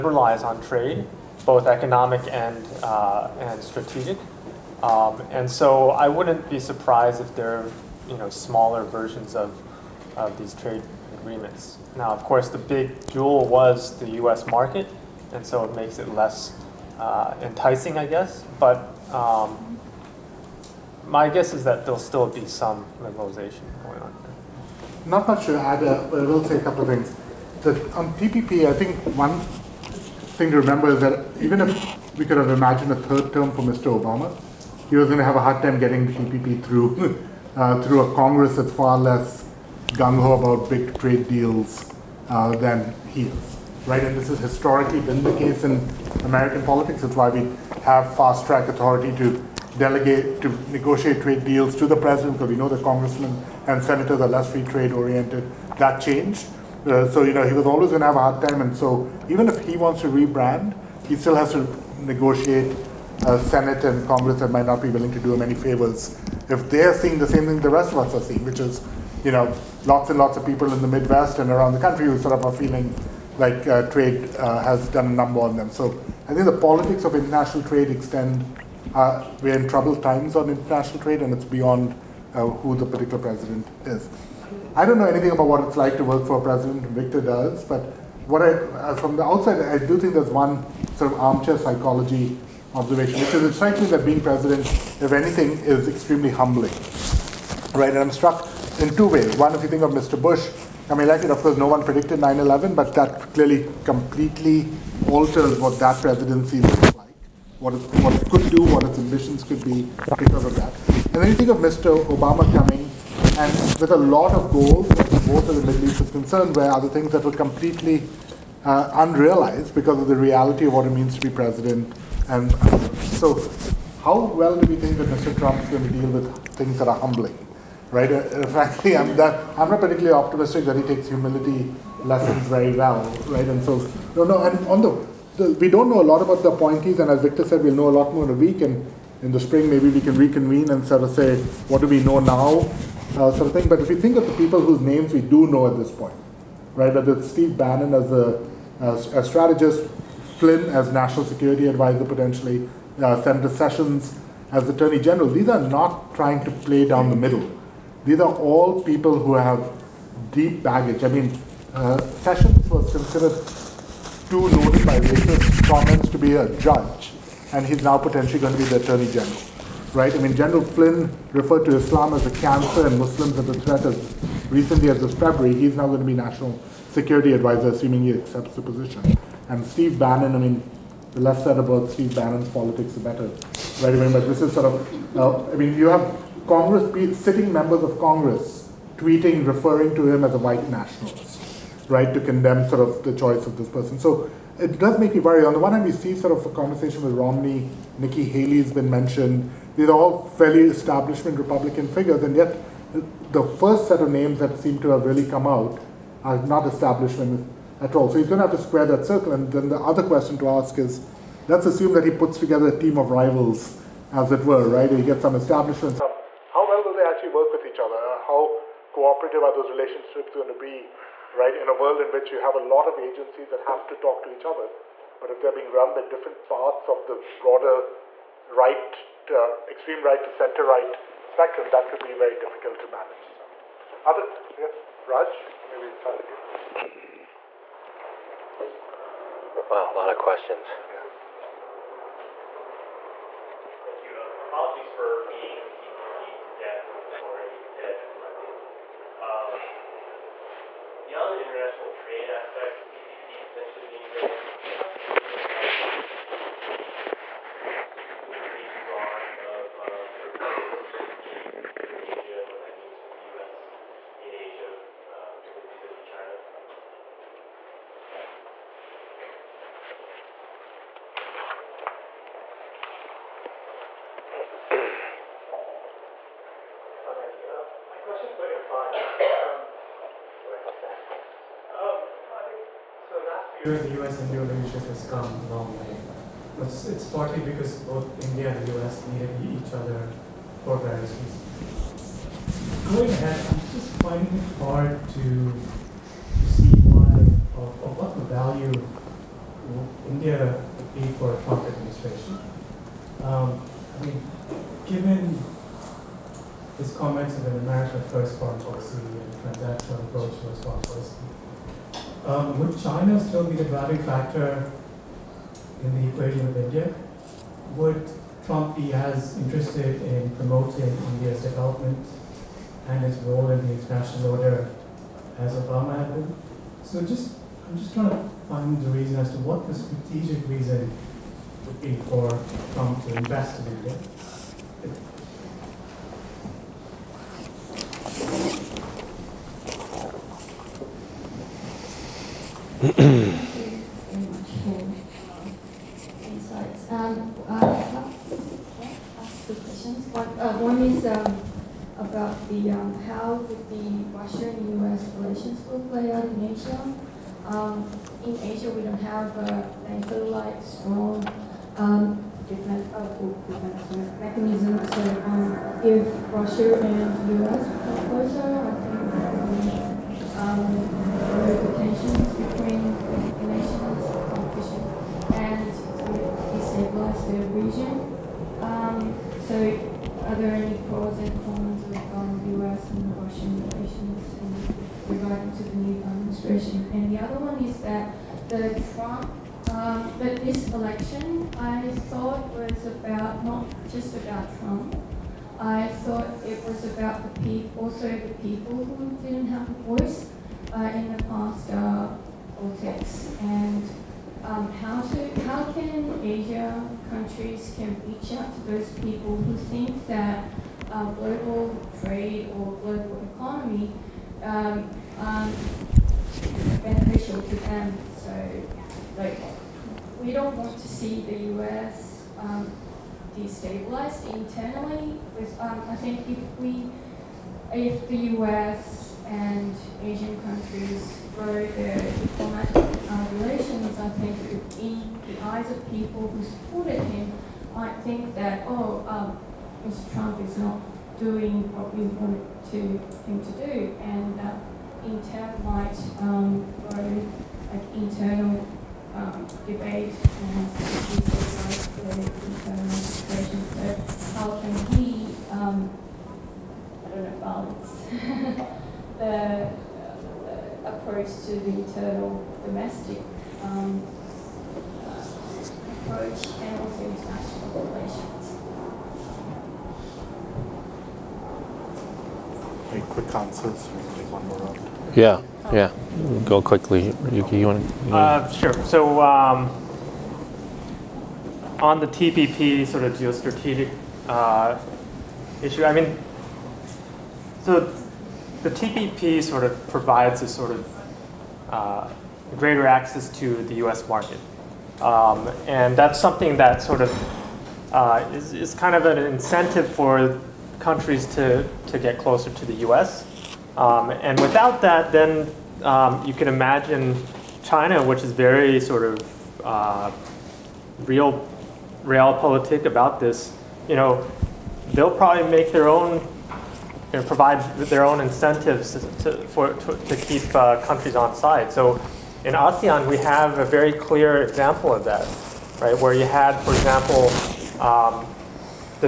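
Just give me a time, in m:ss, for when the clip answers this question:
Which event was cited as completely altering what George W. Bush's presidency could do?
1:42.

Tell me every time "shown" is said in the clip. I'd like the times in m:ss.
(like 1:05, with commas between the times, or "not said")
not said.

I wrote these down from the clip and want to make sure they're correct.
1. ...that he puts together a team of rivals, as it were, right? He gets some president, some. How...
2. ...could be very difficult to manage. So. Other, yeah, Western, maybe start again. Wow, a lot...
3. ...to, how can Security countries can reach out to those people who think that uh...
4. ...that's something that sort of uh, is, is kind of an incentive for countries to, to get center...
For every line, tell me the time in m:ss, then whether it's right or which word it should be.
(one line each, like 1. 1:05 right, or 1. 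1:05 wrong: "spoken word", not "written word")
1. 3:31 wrong: "establishment", not "president"
2. 3:51 wrong: "Raj", not "Western"
3. 6:45 wrong: "Asia", not "Security"
4. 8:15 wrong: "closer", not "center".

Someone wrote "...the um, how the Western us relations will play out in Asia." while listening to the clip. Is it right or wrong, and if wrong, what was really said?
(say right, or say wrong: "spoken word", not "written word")
right.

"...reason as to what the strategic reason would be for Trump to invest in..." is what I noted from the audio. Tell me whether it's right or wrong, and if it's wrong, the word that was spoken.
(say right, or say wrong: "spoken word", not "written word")
right.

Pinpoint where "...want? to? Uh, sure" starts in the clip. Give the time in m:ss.
7:57.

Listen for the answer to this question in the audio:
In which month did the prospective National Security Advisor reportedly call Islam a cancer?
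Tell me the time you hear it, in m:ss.
2:55.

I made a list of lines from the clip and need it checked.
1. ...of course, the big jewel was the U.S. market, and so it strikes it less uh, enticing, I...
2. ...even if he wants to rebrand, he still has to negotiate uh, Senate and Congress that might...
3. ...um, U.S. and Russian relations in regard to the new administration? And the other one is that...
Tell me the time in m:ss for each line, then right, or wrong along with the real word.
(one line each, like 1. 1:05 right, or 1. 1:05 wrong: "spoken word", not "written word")
1. 0:12 wrong: "makes", not "strikes"
2. 0:59 right
3. 6:22 right.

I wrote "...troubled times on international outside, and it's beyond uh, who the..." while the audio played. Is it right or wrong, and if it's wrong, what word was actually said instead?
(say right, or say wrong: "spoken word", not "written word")
wrong: "trade", not "outside".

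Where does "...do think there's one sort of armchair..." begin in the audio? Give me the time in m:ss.
1:29.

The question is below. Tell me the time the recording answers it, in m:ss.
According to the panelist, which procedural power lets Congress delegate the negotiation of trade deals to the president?
0:48.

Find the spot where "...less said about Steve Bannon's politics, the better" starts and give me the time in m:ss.
3:01.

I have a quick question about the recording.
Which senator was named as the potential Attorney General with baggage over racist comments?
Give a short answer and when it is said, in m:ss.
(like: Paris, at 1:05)
Senator Sessions, at 2:33.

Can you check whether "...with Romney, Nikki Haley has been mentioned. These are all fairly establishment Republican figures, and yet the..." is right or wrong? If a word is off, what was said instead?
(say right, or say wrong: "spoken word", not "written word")
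right.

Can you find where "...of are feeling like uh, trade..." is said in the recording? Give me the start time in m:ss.
1:12.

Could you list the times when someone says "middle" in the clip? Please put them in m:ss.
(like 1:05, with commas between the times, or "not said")
1:55, 2:37.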